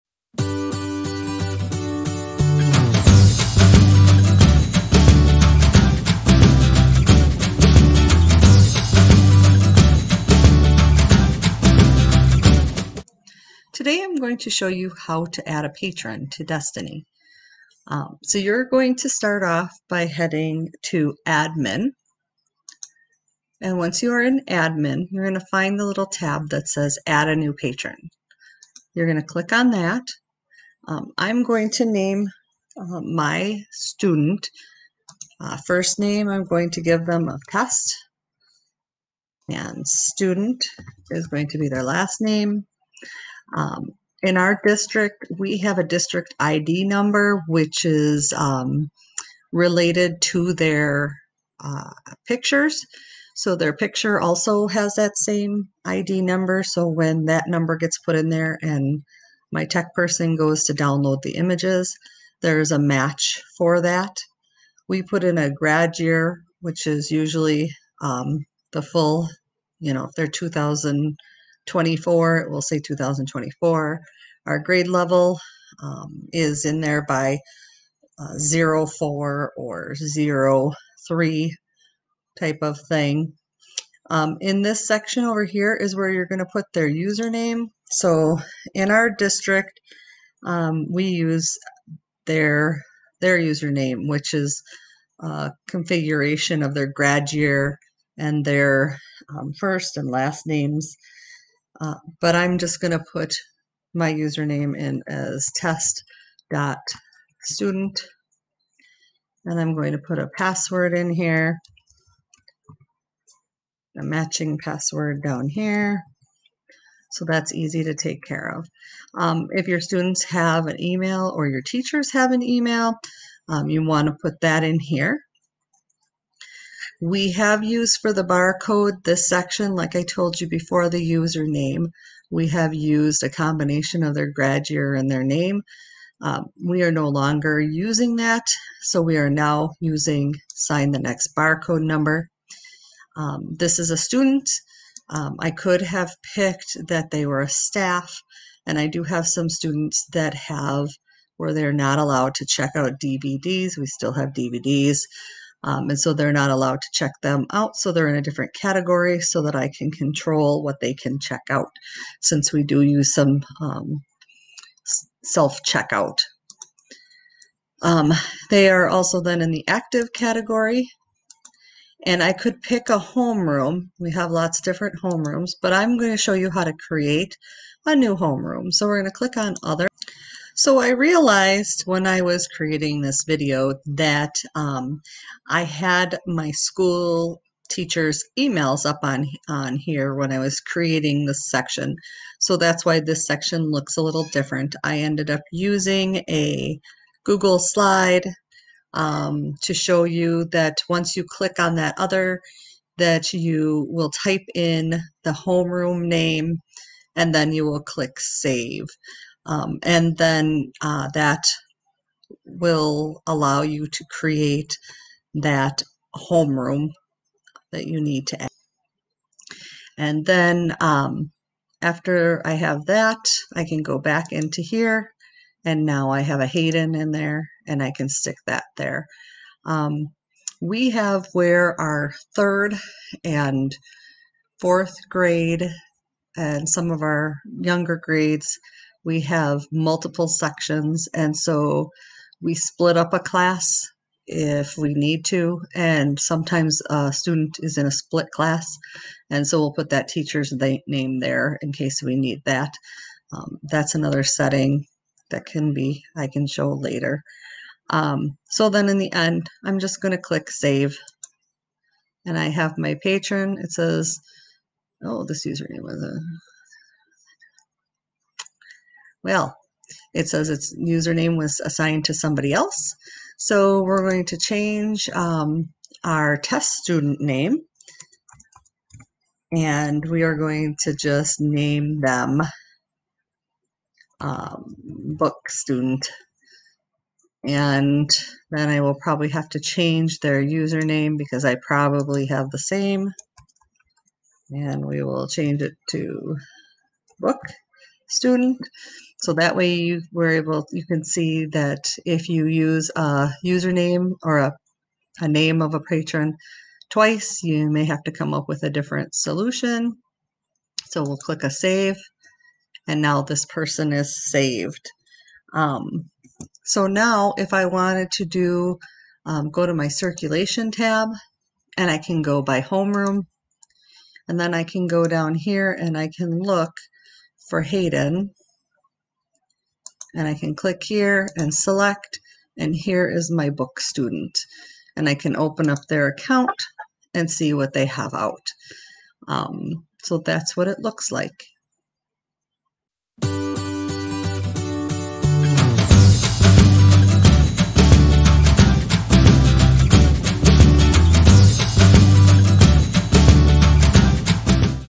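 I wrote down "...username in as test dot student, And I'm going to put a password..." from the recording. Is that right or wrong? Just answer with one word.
right.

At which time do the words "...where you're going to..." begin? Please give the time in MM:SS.
01:25.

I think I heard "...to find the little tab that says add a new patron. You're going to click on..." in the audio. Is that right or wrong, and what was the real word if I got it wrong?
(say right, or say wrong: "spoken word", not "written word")
right.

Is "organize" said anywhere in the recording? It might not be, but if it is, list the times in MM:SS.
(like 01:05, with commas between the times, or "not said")
not said.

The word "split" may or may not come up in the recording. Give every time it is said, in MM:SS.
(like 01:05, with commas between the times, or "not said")
04:02, 04:07.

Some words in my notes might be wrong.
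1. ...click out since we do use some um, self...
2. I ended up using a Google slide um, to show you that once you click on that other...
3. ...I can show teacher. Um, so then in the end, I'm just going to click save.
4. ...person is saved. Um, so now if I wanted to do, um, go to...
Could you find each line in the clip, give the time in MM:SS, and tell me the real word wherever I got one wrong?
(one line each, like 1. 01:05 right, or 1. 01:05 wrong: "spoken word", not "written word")
1. 02:41 wrong: "check", not "click"
2. 03:14 right
3. 04:16 wrong: "later", not "teacher"
4. 05:13 right.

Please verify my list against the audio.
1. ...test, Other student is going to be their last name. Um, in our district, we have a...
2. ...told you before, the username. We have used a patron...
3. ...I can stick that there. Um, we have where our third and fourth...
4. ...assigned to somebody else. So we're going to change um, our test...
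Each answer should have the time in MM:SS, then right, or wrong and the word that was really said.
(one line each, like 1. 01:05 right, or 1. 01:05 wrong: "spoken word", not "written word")
1. 00:37 wrong: "And", not "Other"
2. 02:10 wrong: "combination", not "patron"
3. 03:47 right
4. 04:31 right.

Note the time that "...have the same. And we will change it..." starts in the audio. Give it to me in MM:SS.
04:52.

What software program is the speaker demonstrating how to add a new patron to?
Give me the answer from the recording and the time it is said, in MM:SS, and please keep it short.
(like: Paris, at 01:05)
Destiny, at 00:16.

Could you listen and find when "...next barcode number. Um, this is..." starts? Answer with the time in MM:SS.
02:20.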